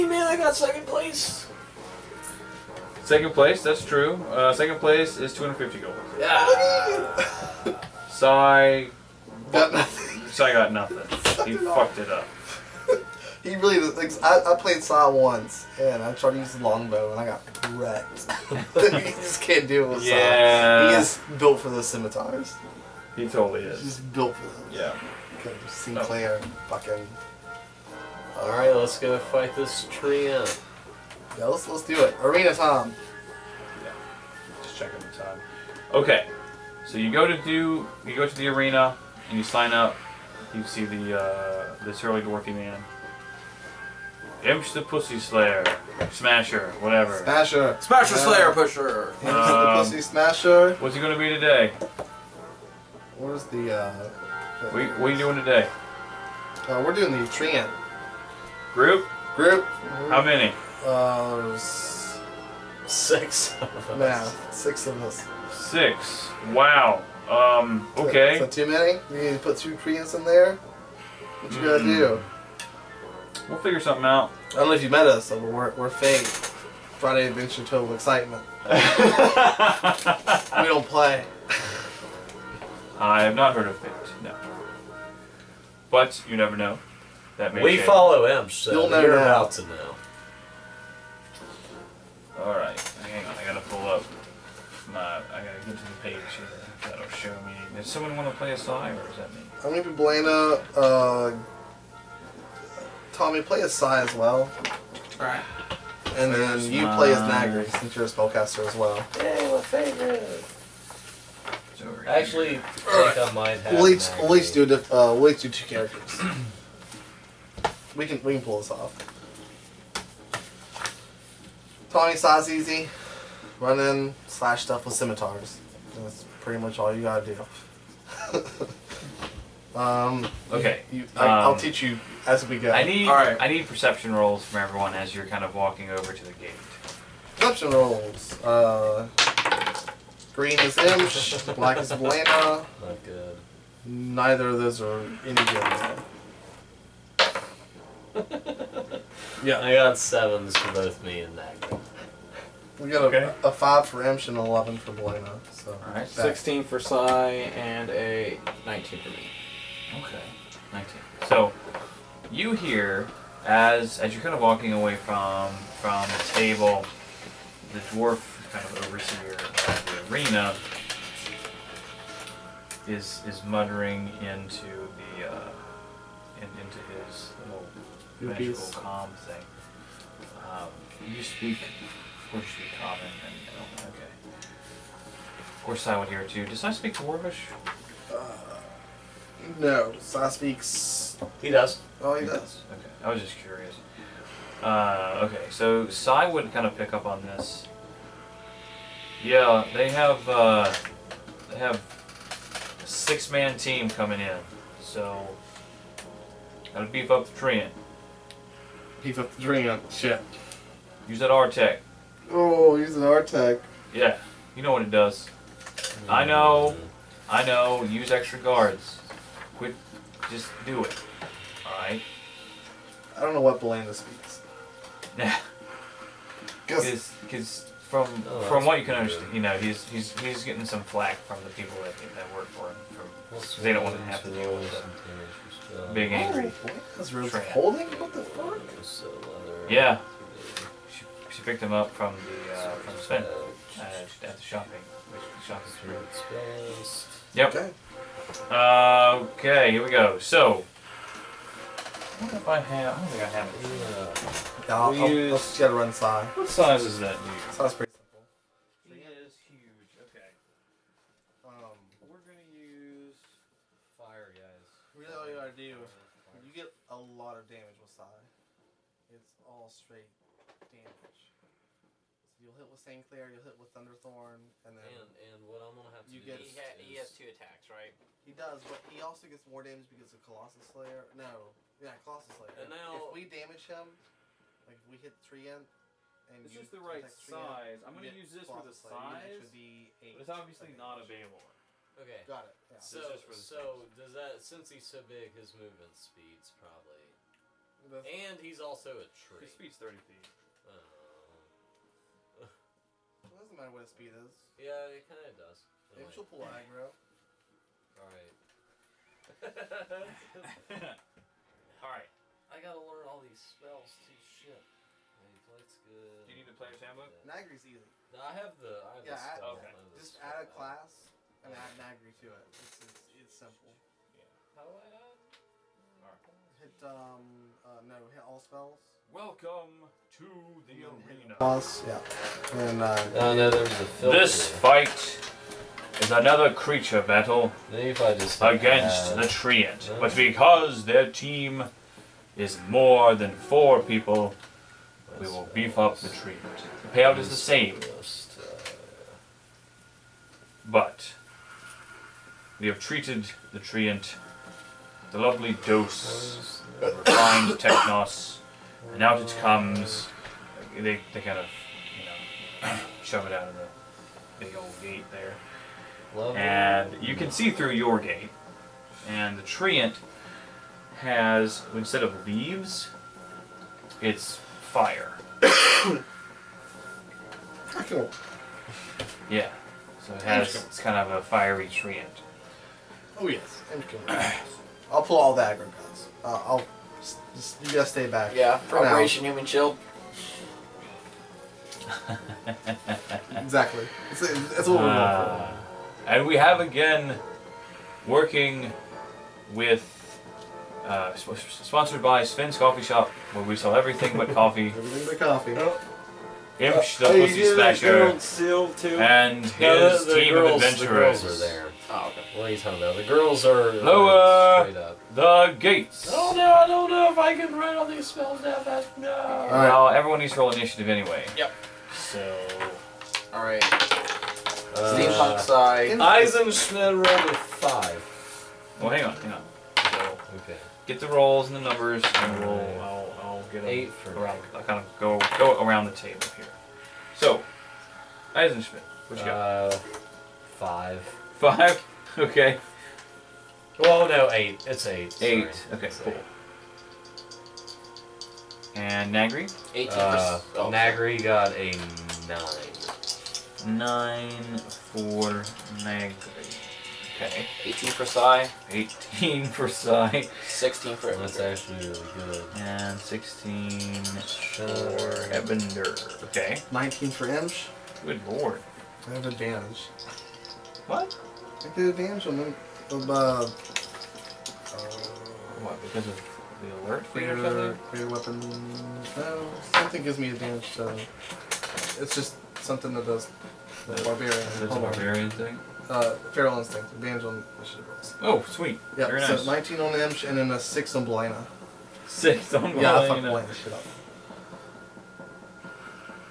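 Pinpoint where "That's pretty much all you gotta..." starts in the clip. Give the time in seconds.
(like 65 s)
126 s.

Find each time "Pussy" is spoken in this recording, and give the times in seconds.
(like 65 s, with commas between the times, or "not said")
44 s, 49 s, 407 s.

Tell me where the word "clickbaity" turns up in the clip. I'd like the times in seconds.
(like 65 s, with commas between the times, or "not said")
not said.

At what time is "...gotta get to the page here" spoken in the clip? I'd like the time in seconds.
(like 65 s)
95 s.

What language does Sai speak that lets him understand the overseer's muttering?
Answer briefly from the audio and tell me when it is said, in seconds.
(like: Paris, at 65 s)
Dwarvish, at 186 s.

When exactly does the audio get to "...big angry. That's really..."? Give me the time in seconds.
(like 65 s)
235 s.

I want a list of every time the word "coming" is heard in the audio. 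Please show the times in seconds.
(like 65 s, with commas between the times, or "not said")
203 s.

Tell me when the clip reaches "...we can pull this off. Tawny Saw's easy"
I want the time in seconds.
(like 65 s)
118 s.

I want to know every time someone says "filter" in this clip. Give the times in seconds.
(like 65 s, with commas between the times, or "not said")
333 s.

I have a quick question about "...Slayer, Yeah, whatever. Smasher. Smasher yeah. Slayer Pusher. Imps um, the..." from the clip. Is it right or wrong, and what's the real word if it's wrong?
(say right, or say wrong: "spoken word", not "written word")
wrong: "Smasher", not "Yeah".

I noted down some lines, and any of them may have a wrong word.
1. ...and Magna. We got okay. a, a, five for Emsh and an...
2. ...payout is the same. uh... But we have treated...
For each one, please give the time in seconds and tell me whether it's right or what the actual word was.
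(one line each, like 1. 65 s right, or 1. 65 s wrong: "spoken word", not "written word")
1. 151 s right
2. 346 s right.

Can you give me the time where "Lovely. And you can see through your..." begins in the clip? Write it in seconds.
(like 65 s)
366 s.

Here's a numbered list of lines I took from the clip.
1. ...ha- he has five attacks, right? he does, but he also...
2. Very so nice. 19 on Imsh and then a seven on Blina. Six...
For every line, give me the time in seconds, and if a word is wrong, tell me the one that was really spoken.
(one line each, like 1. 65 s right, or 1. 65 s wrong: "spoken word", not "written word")
1. 276 s wrong: "two", not "five"
2. 489 s wrong: "six", not "seven".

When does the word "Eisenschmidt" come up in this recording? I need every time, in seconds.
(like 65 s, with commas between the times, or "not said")
425 s, 438 s.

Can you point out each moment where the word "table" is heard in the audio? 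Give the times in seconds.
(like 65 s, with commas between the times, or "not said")
166 s, 435 s.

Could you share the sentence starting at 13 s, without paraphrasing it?
Like, I, I played Sai once, and I tried to use the longbow, and I got wrecked.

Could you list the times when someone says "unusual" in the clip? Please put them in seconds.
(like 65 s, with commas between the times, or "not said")
not said.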